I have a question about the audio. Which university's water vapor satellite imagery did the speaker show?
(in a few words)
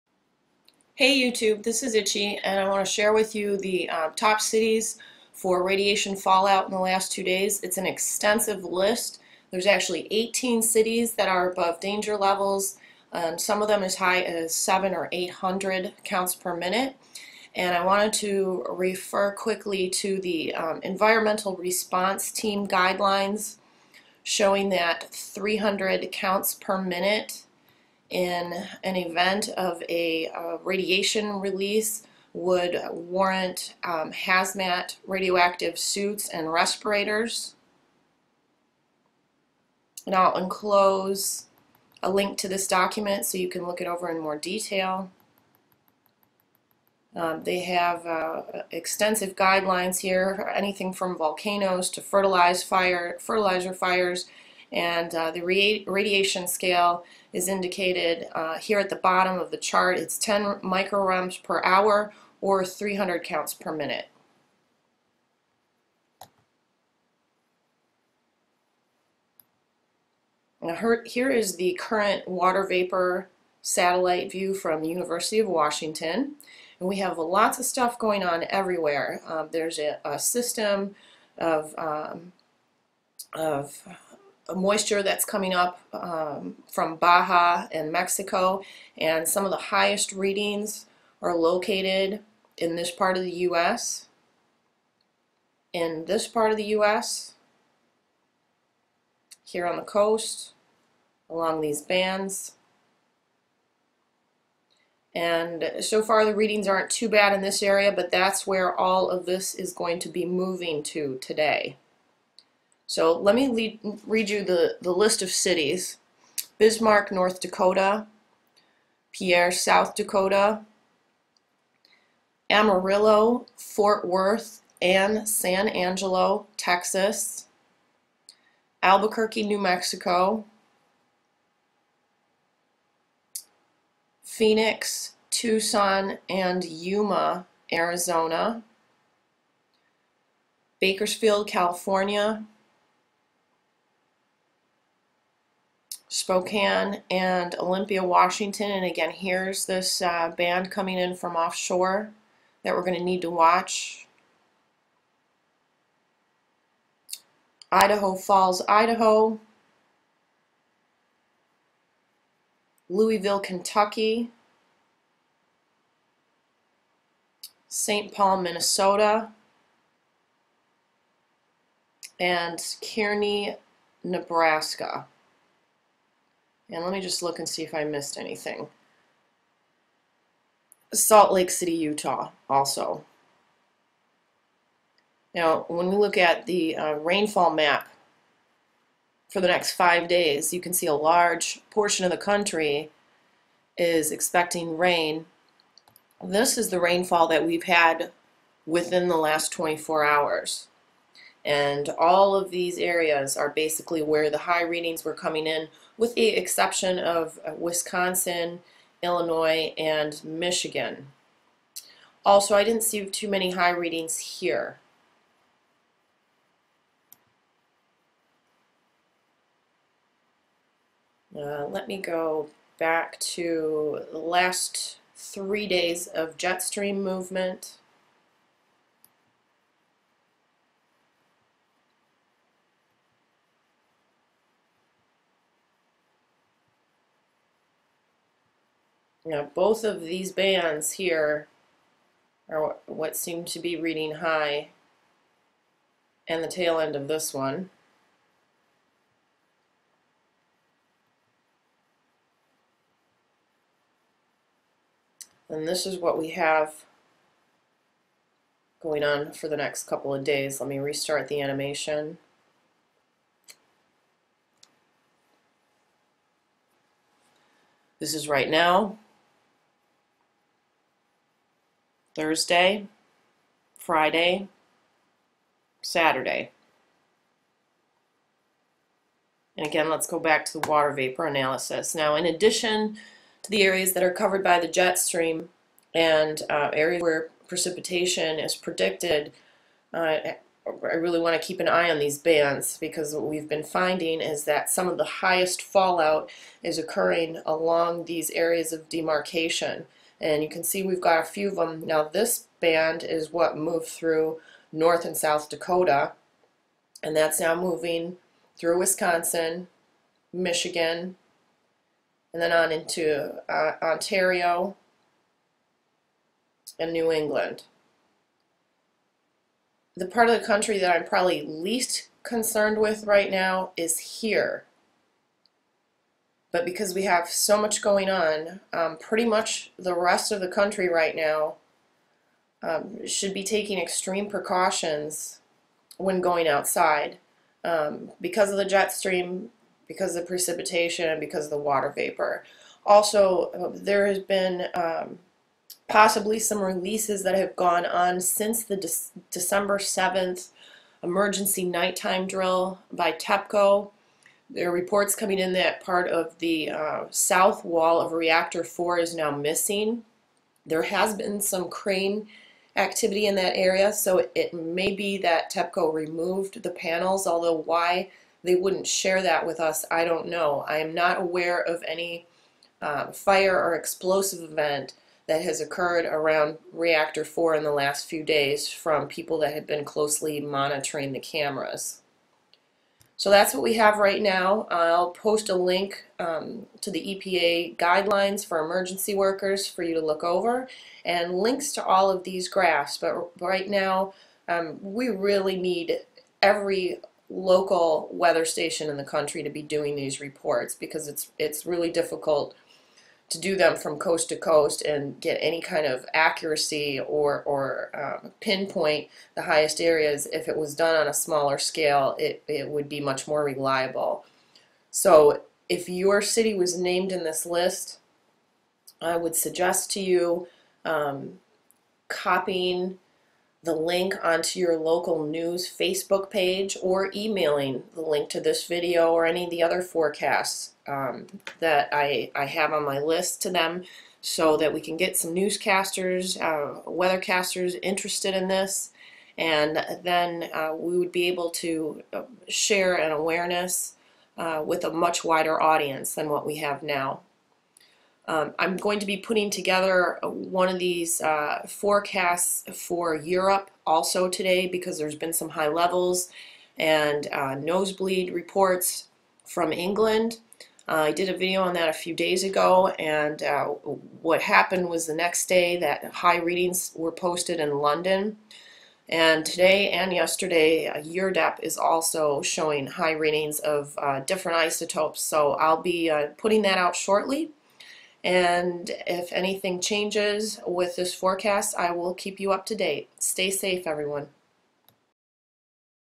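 University of Washington.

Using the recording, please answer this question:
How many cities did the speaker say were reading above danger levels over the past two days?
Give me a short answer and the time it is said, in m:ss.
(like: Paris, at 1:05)
18, at 0:10.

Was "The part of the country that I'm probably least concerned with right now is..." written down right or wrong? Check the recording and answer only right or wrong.
right.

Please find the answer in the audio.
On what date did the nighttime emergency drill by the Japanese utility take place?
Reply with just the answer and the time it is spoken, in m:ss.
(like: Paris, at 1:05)
December 7th, at 5:49.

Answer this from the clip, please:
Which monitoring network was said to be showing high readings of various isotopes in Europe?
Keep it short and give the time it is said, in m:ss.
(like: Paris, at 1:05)
EURDEP, at 7:51.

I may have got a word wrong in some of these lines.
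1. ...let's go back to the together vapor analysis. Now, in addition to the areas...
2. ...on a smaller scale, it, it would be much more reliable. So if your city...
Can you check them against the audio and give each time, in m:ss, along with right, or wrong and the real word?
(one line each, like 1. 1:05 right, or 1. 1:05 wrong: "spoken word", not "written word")
1. 4:39 wrong: "water", not "together"
2. 6:50 right.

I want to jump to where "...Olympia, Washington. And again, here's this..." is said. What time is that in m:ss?
2:27.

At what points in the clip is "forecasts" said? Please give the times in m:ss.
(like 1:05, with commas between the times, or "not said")
7:09, 7:31, 8:01.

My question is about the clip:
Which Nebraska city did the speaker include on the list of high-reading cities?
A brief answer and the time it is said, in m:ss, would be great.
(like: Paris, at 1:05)
Kearney, at 2:52.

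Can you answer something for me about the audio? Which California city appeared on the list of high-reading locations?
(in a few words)
Bakersfield.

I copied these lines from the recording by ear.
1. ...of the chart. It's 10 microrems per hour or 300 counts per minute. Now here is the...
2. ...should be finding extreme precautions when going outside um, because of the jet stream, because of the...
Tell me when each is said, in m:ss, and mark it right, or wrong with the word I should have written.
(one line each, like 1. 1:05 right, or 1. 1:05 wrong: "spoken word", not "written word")
1. 0:59 right
2. 5:33 wrong: "taking", not "finding".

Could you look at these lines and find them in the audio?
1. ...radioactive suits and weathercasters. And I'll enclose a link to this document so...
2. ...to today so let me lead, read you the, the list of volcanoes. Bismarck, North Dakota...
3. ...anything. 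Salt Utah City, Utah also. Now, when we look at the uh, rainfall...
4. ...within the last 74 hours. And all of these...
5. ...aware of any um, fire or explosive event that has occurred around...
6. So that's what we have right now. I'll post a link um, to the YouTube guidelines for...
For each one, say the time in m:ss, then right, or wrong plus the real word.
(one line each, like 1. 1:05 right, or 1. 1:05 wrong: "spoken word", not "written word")
1. 0:35 wrong: "respirators", not "weathercasters"
2. 1:50 wrong: "cities", not "volcanoes"
3. 2:58 wrong: "Lake", not "Utah"
4. 3:18 wrong: "24", not "74"
5. 6:11 right
6. 6:23 wrong: "EPA", not "YouTube".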